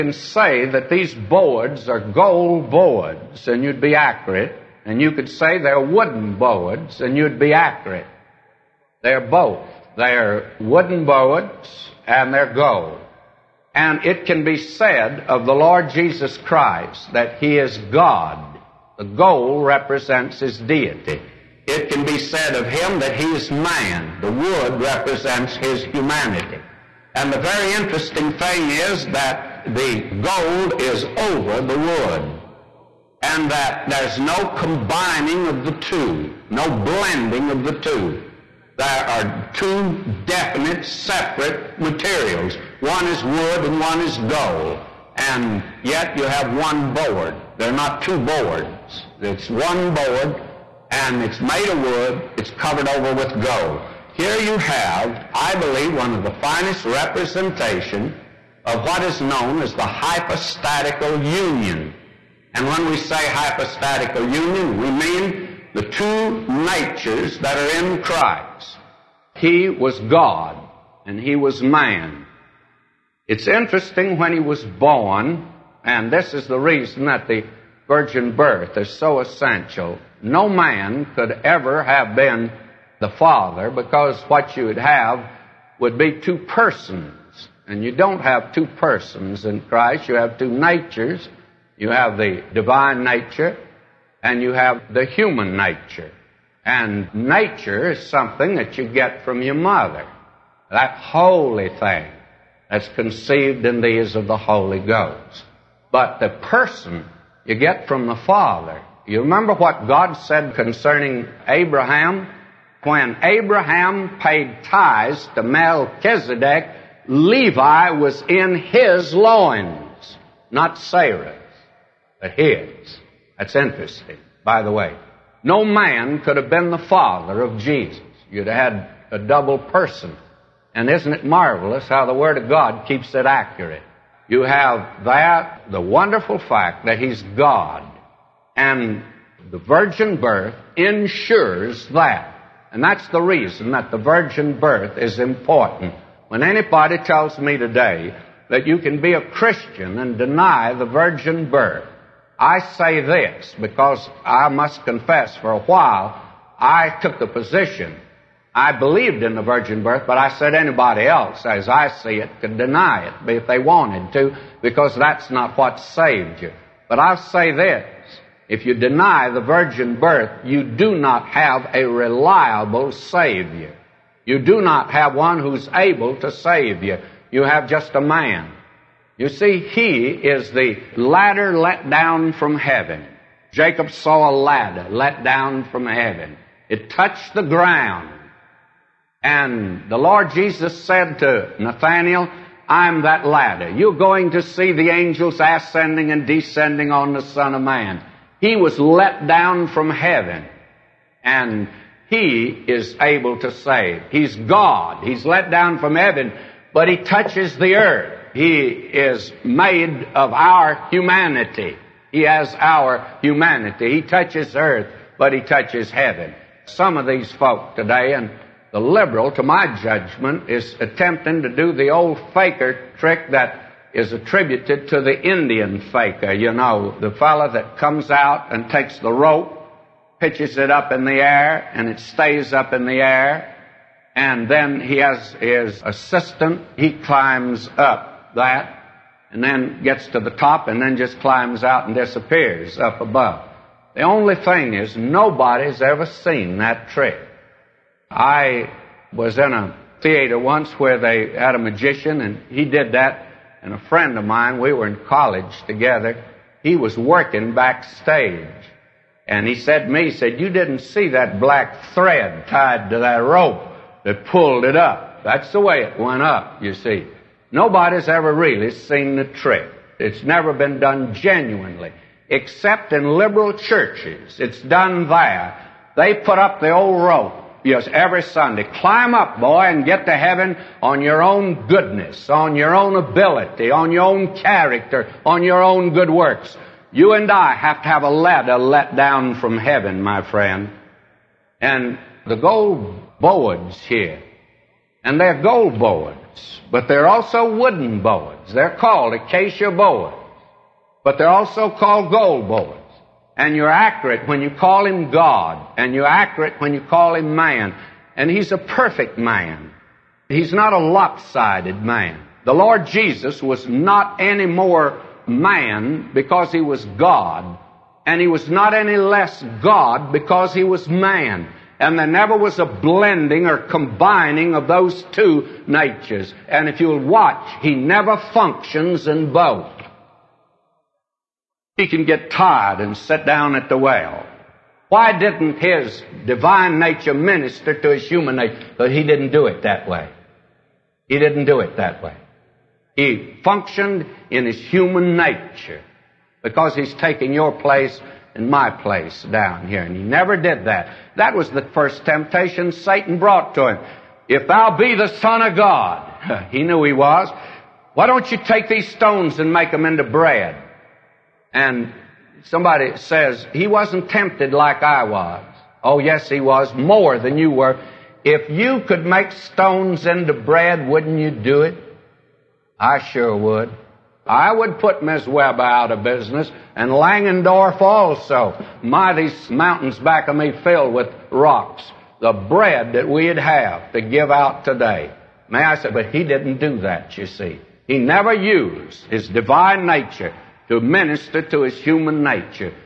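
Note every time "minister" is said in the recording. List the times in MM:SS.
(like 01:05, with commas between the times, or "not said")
05:37, 06:30.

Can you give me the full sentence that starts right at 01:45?
But the person you get from the Father.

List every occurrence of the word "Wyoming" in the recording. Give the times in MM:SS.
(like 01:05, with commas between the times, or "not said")
not said.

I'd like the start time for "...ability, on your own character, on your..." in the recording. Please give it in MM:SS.
04:42.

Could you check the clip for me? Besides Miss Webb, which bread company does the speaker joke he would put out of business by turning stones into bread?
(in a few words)
Langendorf.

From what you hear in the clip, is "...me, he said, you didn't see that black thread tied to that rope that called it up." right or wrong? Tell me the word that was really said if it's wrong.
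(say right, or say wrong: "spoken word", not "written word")
wrong: "pulled", not "called".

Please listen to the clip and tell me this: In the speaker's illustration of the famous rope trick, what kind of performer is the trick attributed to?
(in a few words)
Indian faker.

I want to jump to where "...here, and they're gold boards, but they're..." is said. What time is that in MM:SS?
04:53.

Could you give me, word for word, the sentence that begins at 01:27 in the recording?
And you don't have two persons in Christ.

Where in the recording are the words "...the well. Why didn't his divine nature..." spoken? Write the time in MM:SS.
05:33.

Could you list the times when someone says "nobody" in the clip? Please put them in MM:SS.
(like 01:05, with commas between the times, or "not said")
04:04, 04:27.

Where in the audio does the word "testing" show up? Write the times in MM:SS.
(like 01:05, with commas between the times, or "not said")
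not said.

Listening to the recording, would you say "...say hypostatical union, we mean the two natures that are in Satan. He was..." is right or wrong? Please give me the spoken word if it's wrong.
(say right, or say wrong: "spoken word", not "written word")
wrong: "Christ", not "Satan".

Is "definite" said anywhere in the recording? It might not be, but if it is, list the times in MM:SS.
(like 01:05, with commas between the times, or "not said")
00:40.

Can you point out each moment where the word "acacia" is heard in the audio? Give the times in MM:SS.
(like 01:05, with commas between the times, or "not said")
04:59.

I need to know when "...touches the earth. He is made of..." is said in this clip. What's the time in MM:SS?
03:26.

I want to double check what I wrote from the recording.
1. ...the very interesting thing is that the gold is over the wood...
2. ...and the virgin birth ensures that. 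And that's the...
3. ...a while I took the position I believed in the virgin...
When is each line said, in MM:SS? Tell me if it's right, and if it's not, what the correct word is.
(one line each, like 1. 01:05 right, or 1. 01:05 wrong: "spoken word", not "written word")
1. 00:27 right
2. 02:18 right
3. 02:35 right.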